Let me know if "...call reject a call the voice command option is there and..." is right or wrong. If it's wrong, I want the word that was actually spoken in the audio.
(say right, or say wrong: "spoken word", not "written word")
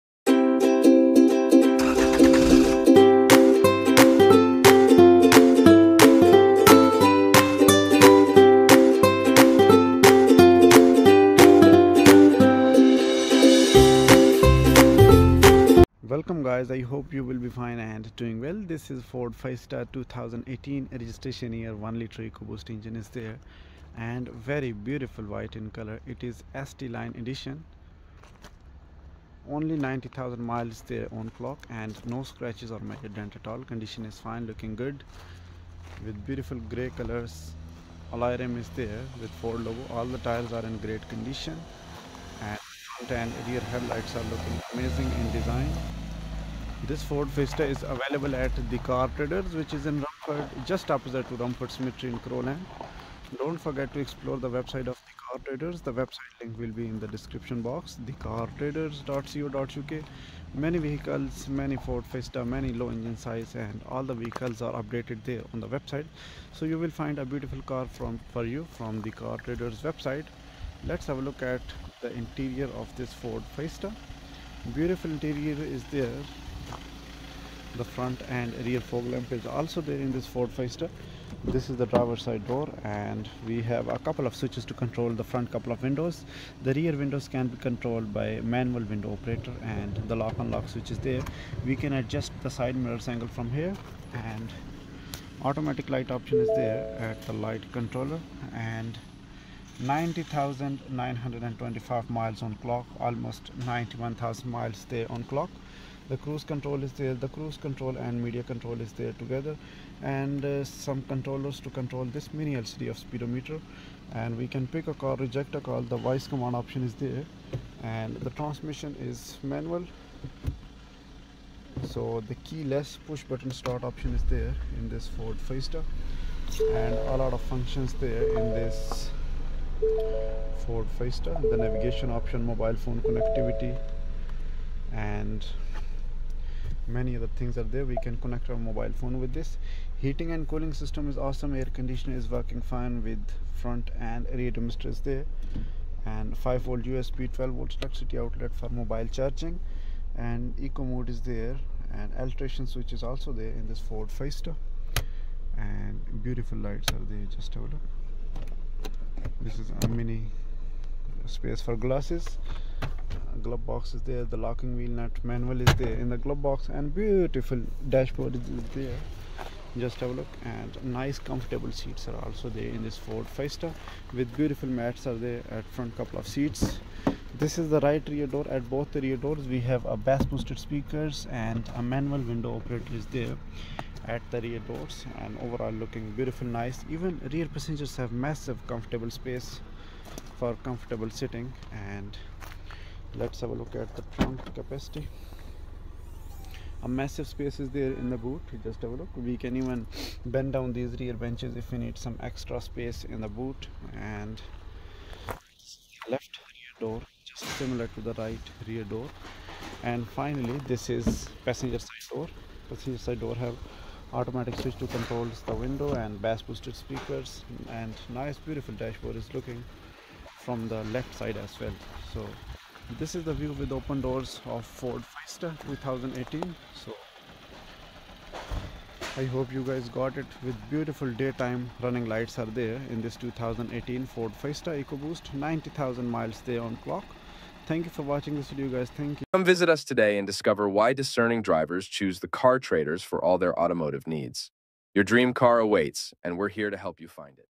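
right.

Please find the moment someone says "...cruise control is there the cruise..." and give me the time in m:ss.
1:46.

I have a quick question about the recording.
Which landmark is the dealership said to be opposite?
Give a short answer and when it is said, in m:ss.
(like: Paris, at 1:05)
Romford Cemetery, at 0:51.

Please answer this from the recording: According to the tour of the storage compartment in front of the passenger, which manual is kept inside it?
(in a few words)
Locking wheel nut manual.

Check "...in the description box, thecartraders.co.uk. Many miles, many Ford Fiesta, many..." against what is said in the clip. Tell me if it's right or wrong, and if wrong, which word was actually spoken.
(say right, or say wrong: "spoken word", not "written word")
wrong: "vehicles", not "miles".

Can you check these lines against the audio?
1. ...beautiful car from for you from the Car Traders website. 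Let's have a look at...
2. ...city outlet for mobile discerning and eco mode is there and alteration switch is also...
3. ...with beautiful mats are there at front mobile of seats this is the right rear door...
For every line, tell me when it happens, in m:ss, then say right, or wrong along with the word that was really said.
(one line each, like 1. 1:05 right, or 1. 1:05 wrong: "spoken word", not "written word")
1. 1:07 right
2. 2:28 wrong: "charging", not "discerning"
3. 2:54 wrong: "couple", not "mobile".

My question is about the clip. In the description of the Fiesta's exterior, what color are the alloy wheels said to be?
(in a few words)
Gray.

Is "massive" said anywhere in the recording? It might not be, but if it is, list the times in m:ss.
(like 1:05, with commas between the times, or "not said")
3:08, 3:16.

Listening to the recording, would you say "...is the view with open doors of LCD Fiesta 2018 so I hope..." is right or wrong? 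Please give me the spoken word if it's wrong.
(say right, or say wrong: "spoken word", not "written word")
wrong: "Ford", not "LCD".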